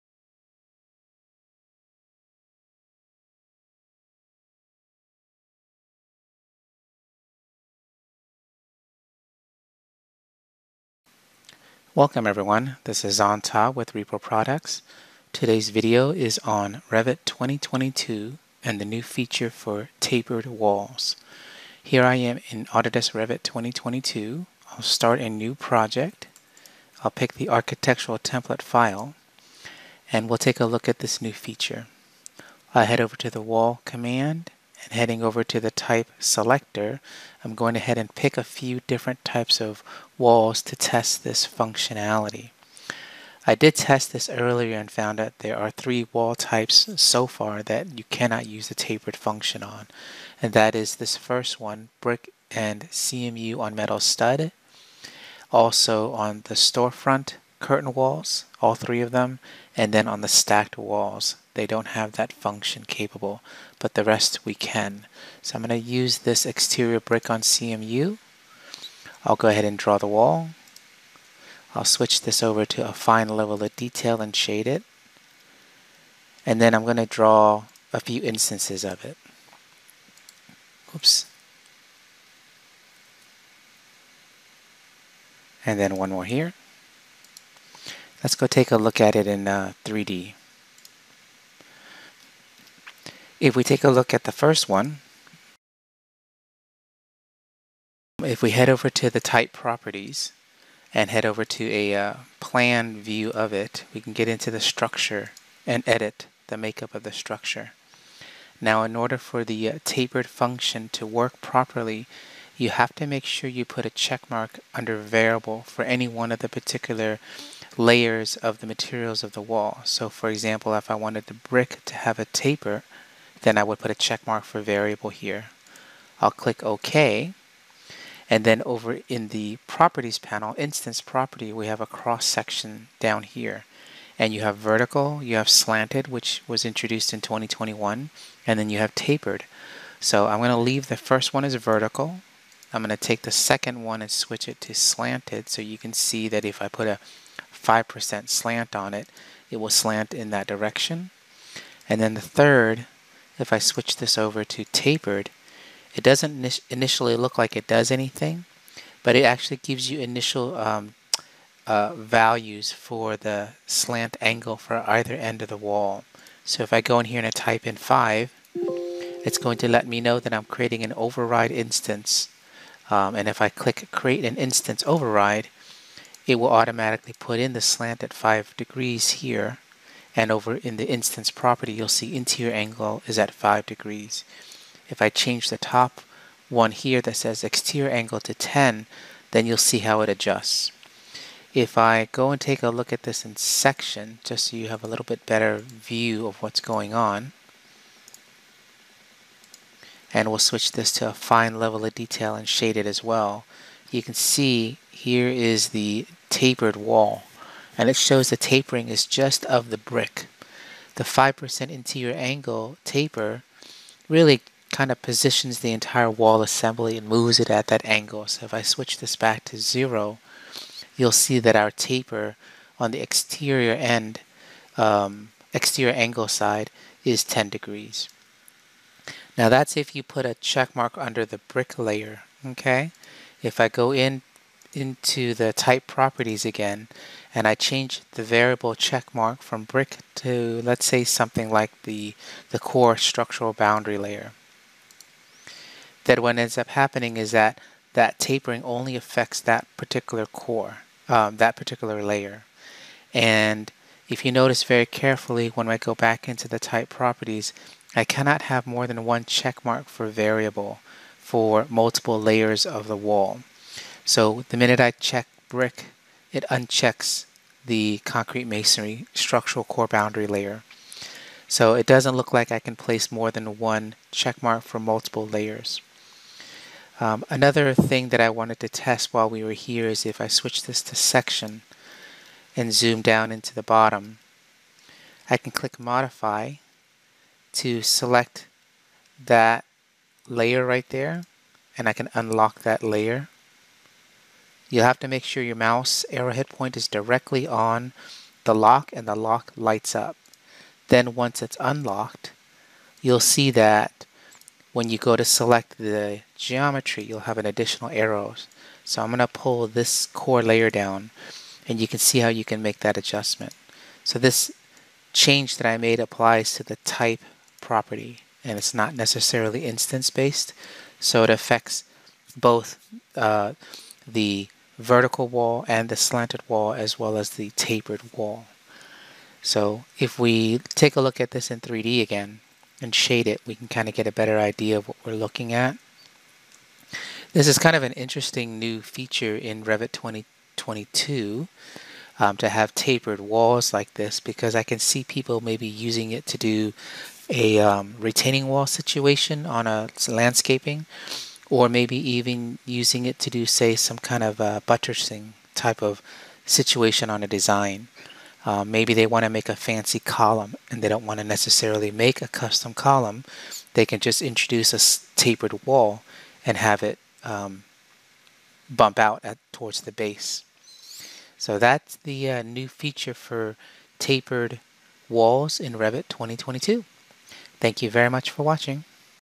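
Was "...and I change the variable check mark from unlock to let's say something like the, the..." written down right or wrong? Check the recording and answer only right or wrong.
wrong.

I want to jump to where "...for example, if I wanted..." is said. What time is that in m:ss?
2:00.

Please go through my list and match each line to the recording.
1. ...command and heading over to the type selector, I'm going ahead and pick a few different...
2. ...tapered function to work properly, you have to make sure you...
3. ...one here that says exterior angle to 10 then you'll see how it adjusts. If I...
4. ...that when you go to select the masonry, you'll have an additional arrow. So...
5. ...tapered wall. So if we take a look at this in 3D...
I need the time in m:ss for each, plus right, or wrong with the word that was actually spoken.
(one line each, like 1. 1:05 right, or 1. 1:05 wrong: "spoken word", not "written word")
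1. 0:33 right
2. 1:49 right
3. 3:06 right
4. 5:03 wrong: "geometry", not "masonry"
5. 5:27 right.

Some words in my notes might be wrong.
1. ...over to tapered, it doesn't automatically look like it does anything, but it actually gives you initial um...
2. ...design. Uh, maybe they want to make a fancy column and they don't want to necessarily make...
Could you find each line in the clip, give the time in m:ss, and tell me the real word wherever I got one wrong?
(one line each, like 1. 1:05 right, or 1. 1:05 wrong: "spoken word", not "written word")
1. 2:34 wrong: "initially", not "automatically"
2. 5:57 right.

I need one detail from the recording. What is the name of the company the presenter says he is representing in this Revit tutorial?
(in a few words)
Repro Products.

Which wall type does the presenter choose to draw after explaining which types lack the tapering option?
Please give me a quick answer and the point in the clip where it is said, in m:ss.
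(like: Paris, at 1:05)
Exterior brick on CMU, at 1:06.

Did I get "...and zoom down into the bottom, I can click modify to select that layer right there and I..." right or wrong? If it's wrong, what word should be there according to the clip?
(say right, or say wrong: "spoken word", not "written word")
right.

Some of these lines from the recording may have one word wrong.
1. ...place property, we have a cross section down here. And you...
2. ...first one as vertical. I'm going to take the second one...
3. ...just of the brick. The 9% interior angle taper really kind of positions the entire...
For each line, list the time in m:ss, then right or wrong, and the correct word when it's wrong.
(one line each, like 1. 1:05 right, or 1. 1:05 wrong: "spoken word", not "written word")
1. 2:10 wrong: "instance", not "place"
2. 2:20 right
3. 3:29 wrong: "5", not "9".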